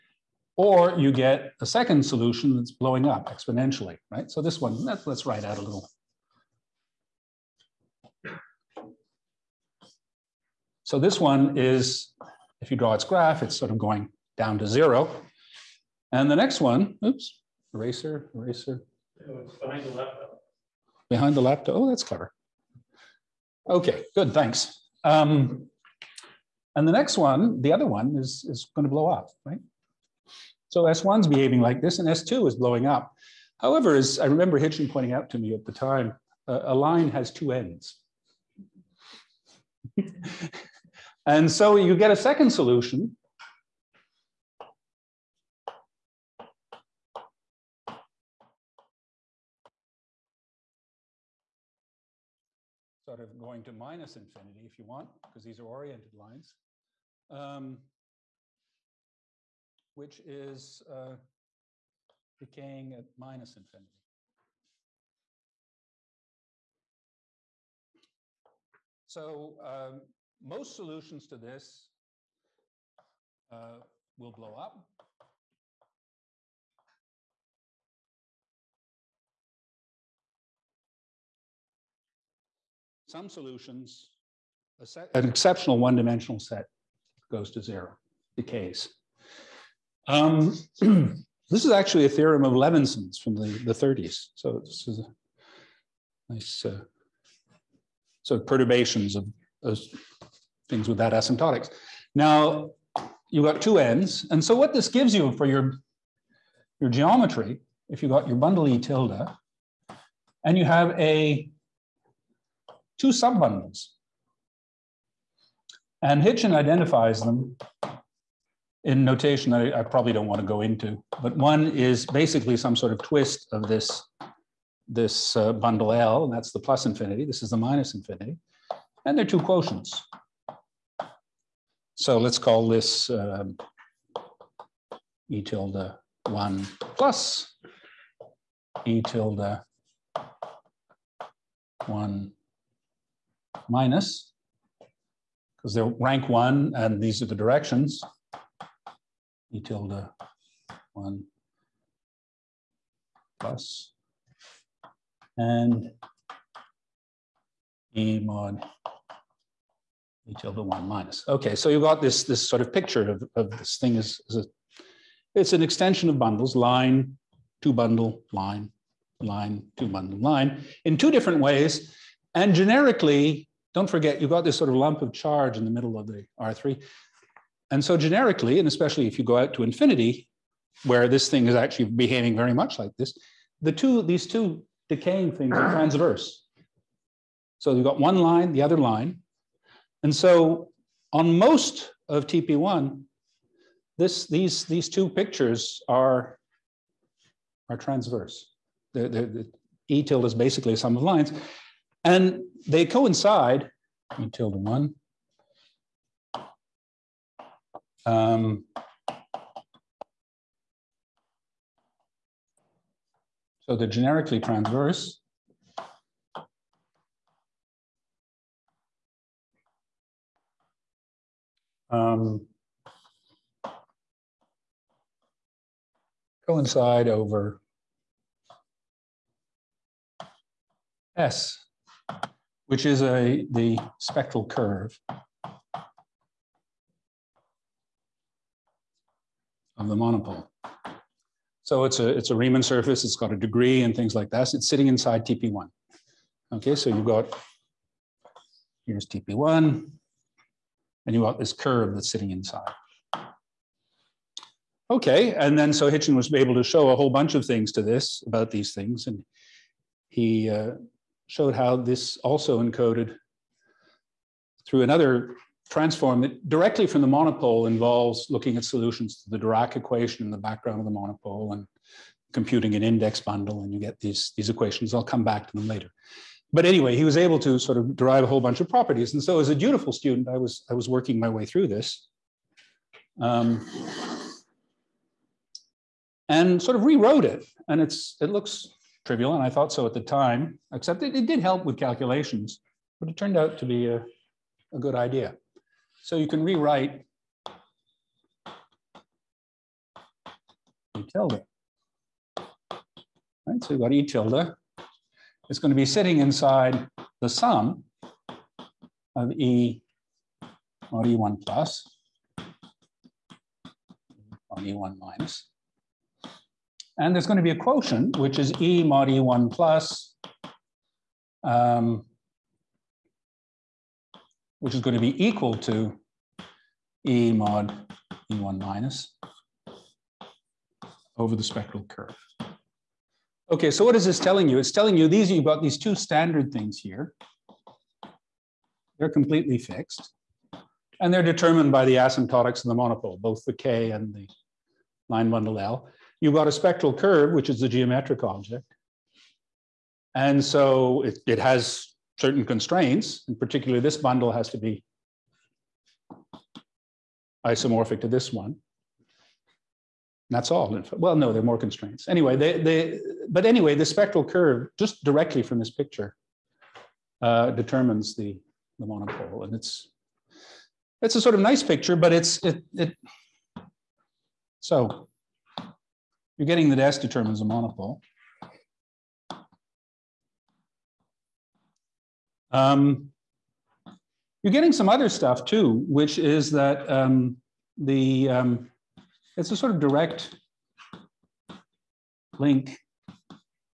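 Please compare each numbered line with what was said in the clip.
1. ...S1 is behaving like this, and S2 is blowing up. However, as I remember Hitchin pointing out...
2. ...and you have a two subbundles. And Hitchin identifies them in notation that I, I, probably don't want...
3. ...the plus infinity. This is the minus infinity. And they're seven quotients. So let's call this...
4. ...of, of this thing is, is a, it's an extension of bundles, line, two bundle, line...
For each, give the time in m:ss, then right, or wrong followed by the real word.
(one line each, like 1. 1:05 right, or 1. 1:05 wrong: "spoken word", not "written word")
1. 0:30 right
2. 1:50 right
3. 2:06 wrong: "two", not "seven"
4. 2:43 right.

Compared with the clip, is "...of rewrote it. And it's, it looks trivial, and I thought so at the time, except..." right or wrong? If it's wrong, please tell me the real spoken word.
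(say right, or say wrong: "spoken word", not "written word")
right.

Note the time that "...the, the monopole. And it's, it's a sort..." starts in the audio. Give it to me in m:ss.
6:08.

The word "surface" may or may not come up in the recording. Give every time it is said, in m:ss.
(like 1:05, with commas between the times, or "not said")
4:02.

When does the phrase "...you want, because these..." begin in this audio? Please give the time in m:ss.
0:54.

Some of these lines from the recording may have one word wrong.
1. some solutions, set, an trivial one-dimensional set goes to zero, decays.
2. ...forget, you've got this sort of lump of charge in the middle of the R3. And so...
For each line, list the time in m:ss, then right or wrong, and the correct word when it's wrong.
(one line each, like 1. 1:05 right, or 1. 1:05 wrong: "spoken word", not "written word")
1. 1:23 wrong: "exceptional", not "trivial"
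2. 2:53 right.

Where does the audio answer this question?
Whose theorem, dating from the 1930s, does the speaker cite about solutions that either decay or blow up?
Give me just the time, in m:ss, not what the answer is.
1:32.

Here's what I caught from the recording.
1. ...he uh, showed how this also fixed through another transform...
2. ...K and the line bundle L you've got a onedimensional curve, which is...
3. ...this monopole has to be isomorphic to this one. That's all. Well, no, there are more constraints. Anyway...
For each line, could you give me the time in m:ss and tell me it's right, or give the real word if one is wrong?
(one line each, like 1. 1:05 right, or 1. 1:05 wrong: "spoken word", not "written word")
1. 4:20 wrong: "encoded", not "fixed"
2. 5:43 wrong: "spectral", not "onedimensional"
3. 5:53 wrong: "bundle", not "monopole".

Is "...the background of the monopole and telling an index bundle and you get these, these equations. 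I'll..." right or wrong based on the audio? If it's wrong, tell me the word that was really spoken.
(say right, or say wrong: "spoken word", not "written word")
wrong: "computing", not "telling".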